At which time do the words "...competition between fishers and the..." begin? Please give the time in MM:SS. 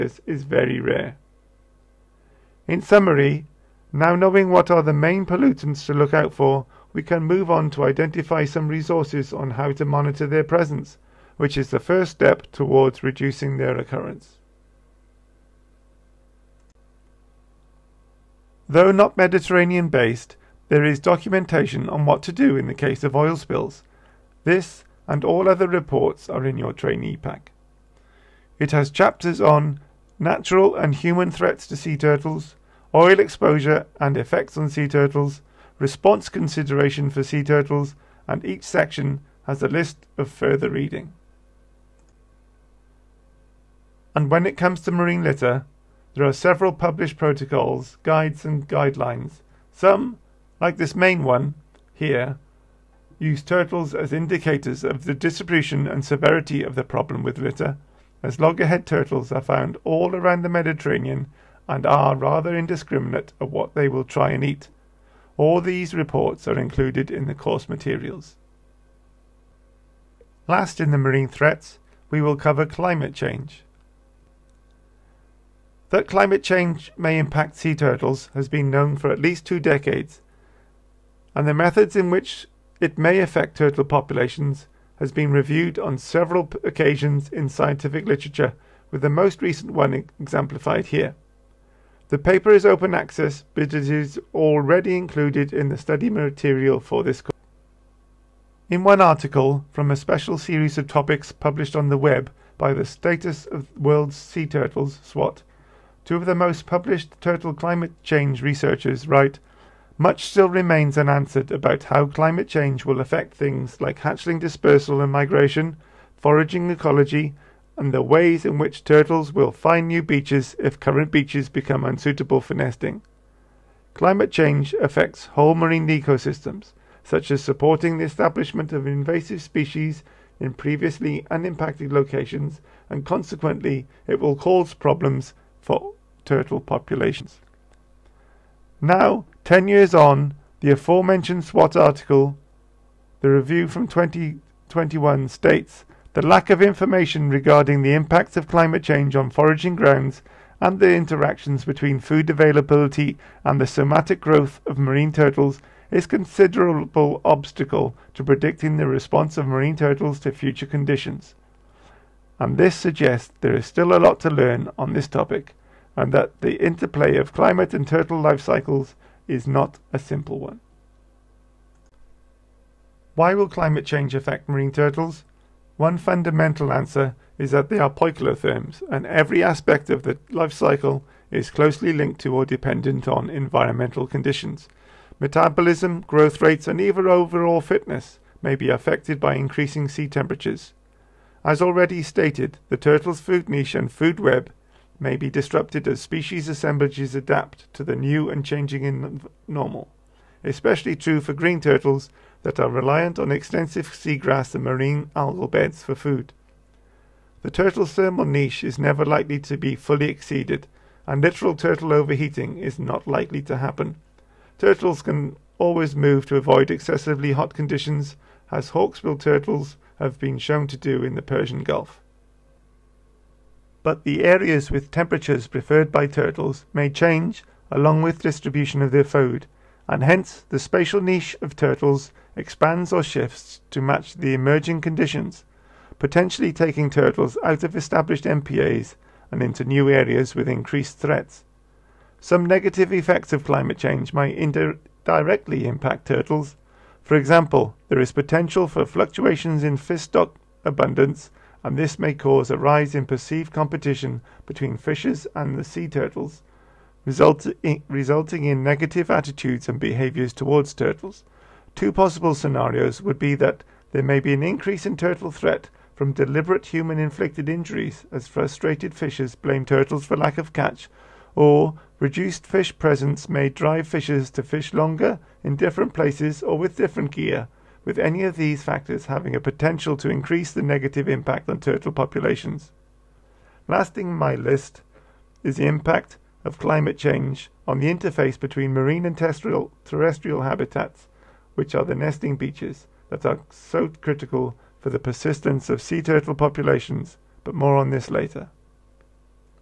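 04:13.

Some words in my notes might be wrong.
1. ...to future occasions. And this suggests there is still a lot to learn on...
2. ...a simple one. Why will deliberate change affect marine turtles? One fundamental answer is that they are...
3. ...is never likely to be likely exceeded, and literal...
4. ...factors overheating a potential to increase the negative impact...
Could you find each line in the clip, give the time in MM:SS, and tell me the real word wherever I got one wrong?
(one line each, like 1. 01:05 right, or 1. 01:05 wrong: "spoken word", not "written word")
1. 02:40 wrong: "conditions", not "occasions"
2. 02:49 wrong: "climate", not "deliberate"
3. 03:28 wrong: "fully", not "likely"
4. 04:38 wrong: "having", not "overheating".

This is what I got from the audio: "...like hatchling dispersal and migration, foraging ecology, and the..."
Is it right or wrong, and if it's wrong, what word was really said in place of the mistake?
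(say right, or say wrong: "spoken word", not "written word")
right.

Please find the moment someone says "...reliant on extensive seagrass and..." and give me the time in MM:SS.
03:22.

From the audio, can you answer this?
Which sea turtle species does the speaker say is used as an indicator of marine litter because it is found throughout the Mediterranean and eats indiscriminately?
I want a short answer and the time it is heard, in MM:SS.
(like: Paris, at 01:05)
Loggerhead turtles, at 00:58.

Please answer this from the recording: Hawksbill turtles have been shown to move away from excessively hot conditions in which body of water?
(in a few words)
Persian Gulf.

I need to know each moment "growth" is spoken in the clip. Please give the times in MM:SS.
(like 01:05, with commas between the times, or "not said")
02:34, 03:06.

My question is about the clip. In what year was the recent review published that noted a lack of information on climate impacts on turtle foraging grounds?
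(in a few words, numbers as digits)
2021.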